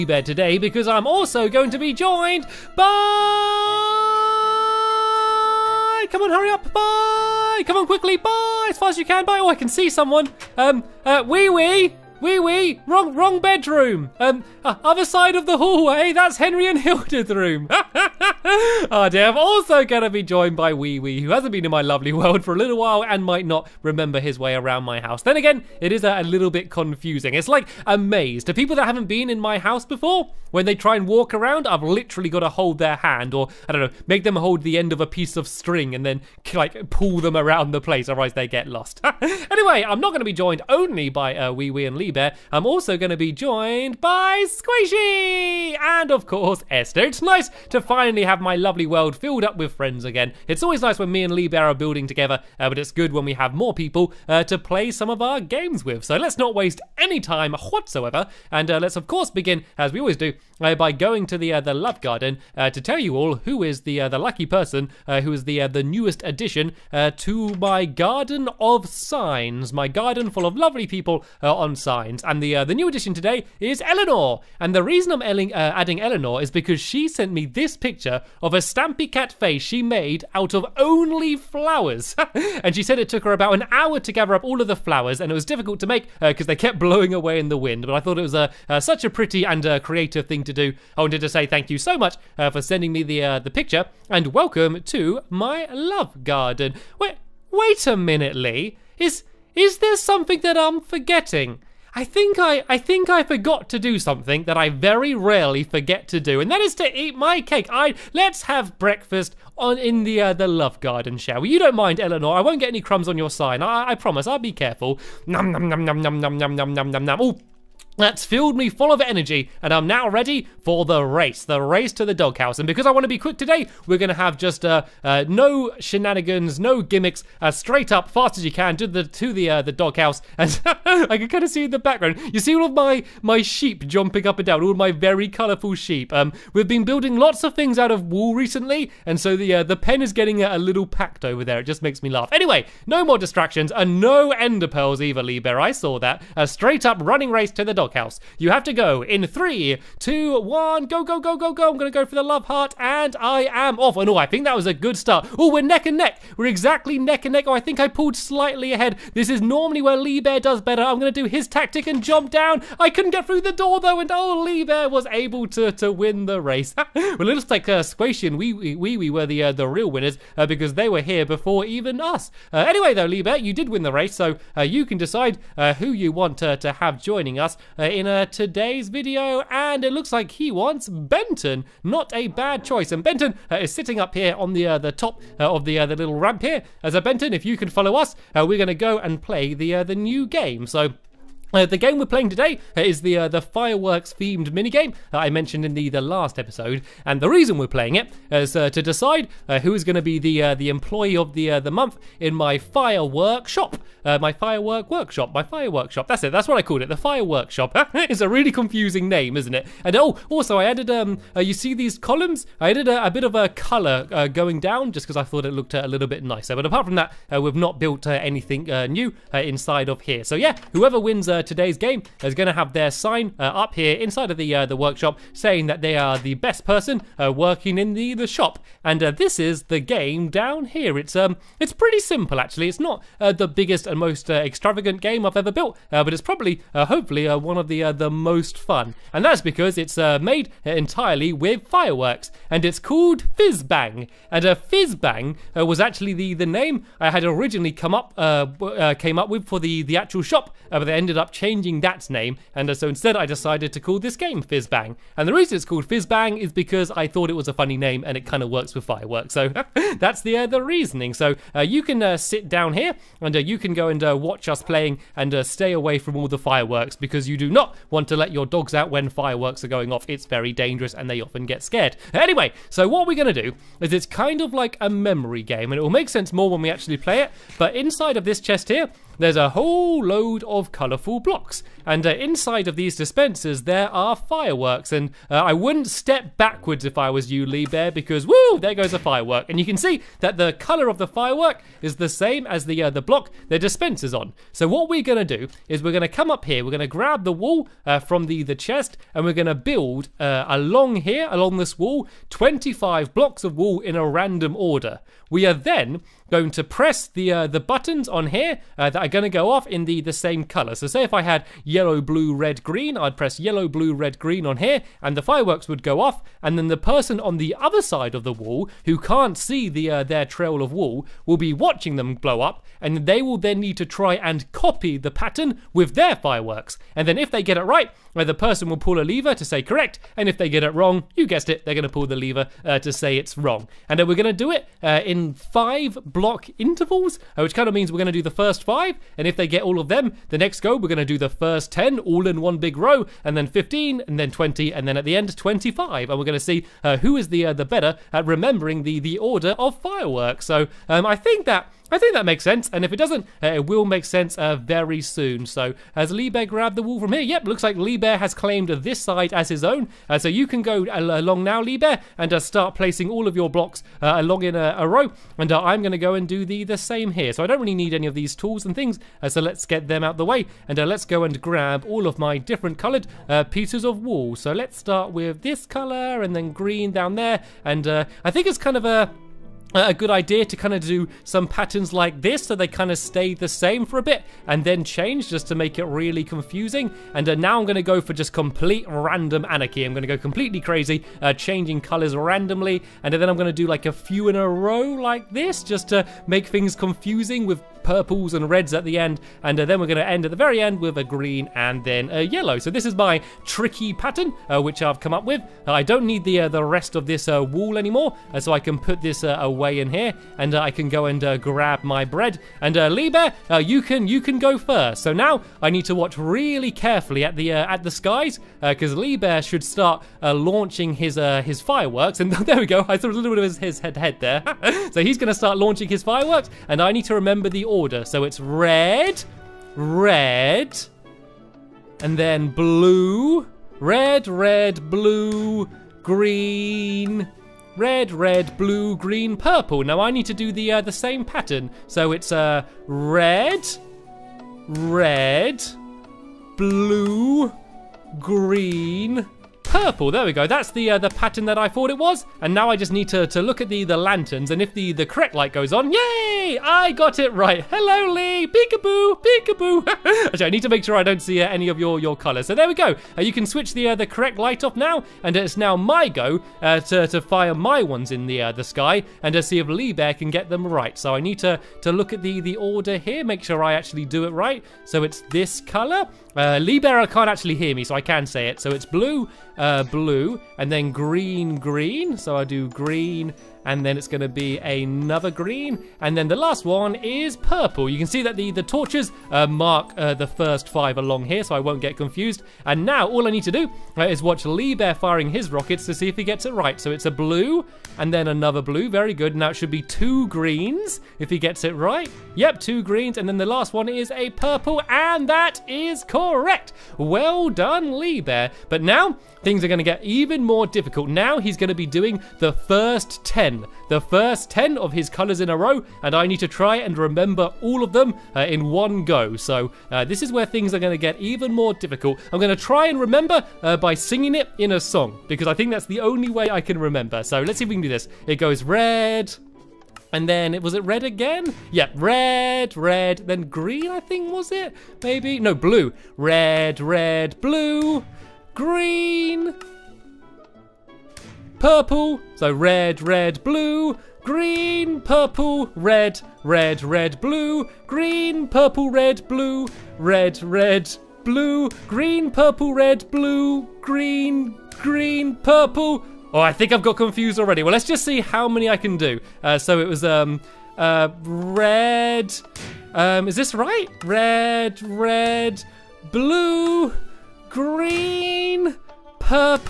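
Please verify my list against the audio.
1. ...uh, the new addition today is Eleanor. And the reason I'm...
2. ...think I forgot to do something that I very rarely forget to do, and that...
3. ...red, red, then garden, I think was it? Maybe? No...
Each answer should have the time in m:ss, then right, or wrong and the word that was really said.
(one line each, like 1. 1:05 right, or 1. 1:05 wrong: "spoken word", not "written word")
1. 1:12 right
2. 1:42 right
3. 8:51 wrong: "green", not "garden".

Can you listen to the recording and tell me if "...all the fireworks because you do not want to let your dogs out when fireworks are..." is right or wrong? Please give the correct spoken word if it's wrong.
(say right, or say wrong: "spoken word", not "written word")
right.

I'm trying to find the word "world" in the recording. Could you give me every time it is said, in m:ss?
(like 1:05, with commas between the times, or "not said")
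0:22, 0:48.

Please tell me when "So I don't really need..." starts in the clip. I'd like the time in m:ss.
6:07.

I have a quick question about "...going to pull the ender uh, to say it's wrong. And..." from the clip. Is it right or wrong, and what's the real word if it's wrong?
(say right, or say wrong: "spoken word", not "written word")
wrong: "lever", not "ender".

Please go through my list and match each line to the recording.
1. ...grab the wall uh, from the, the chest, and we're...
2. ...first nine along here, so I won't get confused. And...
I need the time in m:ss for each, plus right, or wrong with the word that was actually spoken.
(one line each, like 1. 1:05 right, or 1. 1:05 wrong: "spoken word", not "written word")
1. 4:56 right
2. 8:10 wrong: "five", not "nine".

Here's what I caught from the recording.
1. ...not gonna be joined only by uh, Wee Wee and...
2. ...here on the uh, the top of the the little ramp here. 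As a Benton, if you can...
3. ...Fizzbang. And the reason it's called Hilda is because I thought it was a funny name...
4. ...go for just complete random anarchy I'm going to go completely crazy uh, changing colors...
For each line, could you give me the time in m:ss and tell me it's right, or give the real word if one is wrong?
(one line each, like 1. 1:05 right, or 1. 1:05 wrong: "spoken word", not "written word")
1. 0:39 right
2. 3:04 right
3. 4:14 wrong: "Fizzbang", not "Hilda"
4. 6:27 right.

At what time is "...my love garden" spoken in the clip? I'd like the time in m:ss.
1:35.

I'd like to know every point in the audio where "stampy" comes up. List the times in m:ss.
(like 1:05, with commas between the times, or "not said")
1:18.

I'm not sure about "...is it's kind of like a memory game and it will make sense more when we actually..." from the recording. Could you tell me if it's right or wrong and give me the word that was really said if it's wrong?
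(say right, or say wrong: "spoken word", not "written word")
right.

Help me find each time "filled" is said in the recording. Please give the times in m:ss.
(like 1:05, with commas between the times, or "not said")
0:49, 1:58.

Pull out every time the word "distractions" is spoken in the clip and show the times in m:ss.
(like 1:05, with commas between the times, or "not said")
2:23.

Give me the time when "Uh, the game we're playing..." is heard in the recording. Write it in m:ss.
3:11.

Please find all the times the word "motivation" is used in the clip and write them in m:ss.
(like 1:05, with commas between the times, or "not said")
not said.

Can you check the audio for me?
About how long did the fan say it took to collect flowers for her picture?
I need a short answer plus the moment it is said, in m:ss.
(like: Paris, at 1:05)
About an hour, at 1:23.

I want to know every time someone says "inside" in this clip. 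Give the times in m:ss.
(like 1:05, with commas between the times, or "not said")
3:39, 3:43, 4:37, 4:42.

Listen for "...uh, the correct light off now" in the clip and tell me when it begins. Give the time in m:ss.
7:43.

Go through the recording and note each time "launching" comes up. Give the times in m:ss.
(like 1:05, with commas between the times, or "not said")
7:00, 7:05.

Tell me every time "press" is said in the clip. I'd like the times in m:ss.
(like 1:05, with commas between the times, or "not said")
5:06, 5:13.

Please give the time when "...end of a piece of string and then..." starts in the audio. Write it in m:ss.
0:34.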